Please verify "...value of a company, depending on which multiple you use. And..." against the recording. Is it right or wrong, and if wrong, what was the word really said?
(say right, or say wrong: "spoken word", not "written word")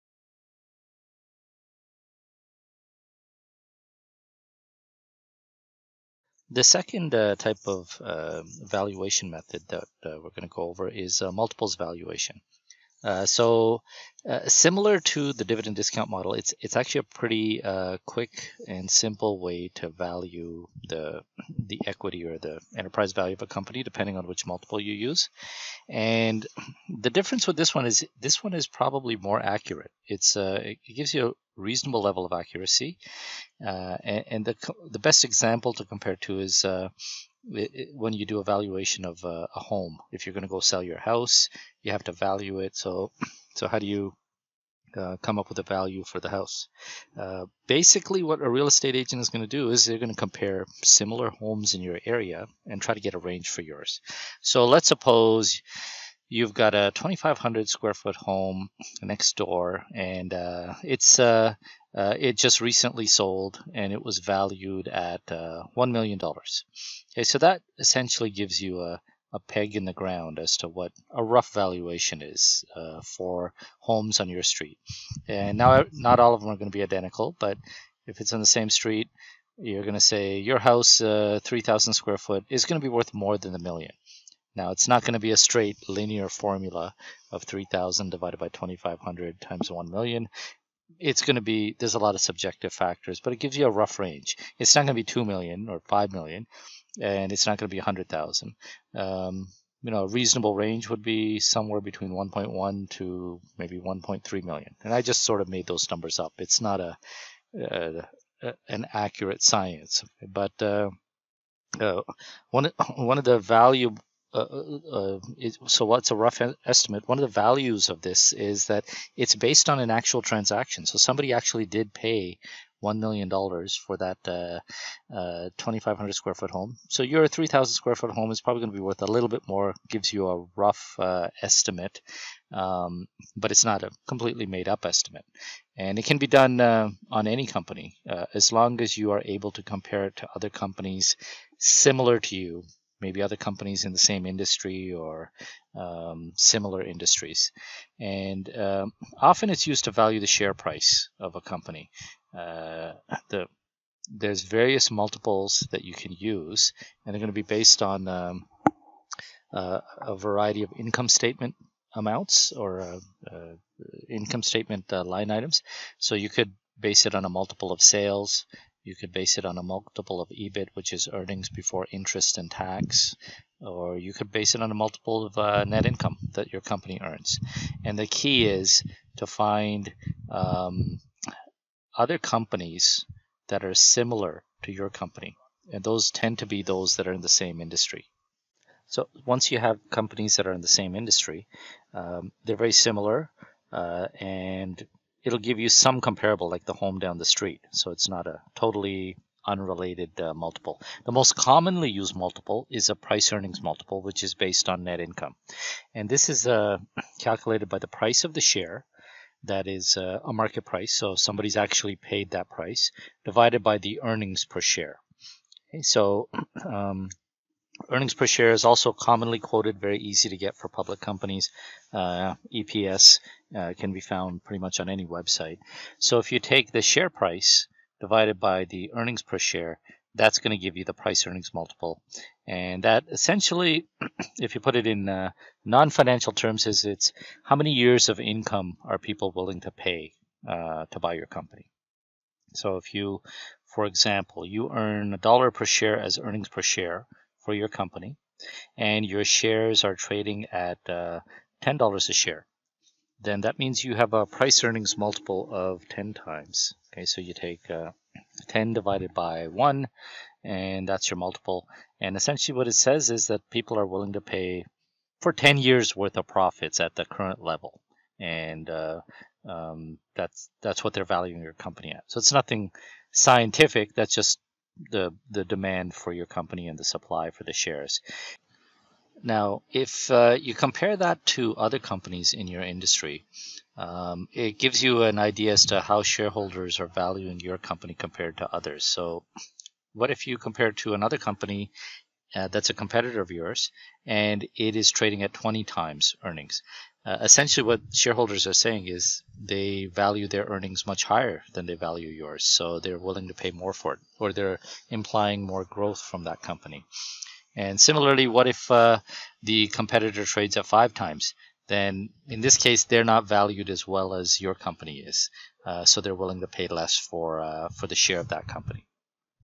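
right.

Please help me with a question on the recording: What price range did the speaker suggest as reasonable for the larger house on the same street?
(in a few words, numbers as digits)
1.1 to 1.3 million.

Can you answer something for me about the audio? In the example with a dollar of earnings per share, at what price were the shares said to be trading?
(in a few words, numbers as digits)
$10.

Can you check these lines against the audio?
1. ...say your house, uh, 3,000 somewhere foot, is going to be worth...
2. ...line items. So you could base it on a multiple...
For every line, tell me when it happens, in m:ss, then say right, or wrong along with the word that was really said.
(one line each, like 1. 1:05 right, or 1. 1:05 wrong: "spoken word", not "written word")
1. 1:20 wrong: "square", not "somewhere"
2. 2:45 right.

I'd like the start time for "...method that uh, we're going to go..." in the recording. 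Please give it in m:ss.
0:09.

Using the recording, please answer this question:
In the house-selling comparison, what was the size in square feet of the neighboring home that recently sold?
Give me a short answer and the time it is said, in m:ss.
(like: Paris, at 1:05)
2,500, at 0:56.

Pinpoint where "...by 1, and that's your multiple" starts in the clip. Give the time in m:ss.
4:19.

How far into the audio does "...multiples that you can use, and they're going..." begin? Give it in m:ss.
2:34.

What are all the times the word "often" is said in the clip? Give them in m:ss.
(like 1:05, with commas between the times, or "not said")
2:29.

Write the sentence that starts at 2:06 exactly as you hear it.
So your 3,000 square foot home is probably going to be worth a little bit more.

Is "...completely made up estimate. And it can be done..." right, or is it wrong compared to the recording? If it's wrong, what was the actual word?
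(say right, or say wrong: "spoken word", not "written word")
right.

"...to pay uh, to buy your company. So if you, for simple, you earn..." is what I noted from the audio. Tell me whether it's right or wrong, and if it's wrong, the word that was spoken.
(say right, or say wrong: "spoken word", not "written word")
wrong: "example", not "simple".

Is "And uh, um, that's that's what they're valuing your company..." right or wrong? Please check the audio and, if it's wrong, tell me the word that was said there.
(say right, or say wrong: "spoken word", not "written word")
right.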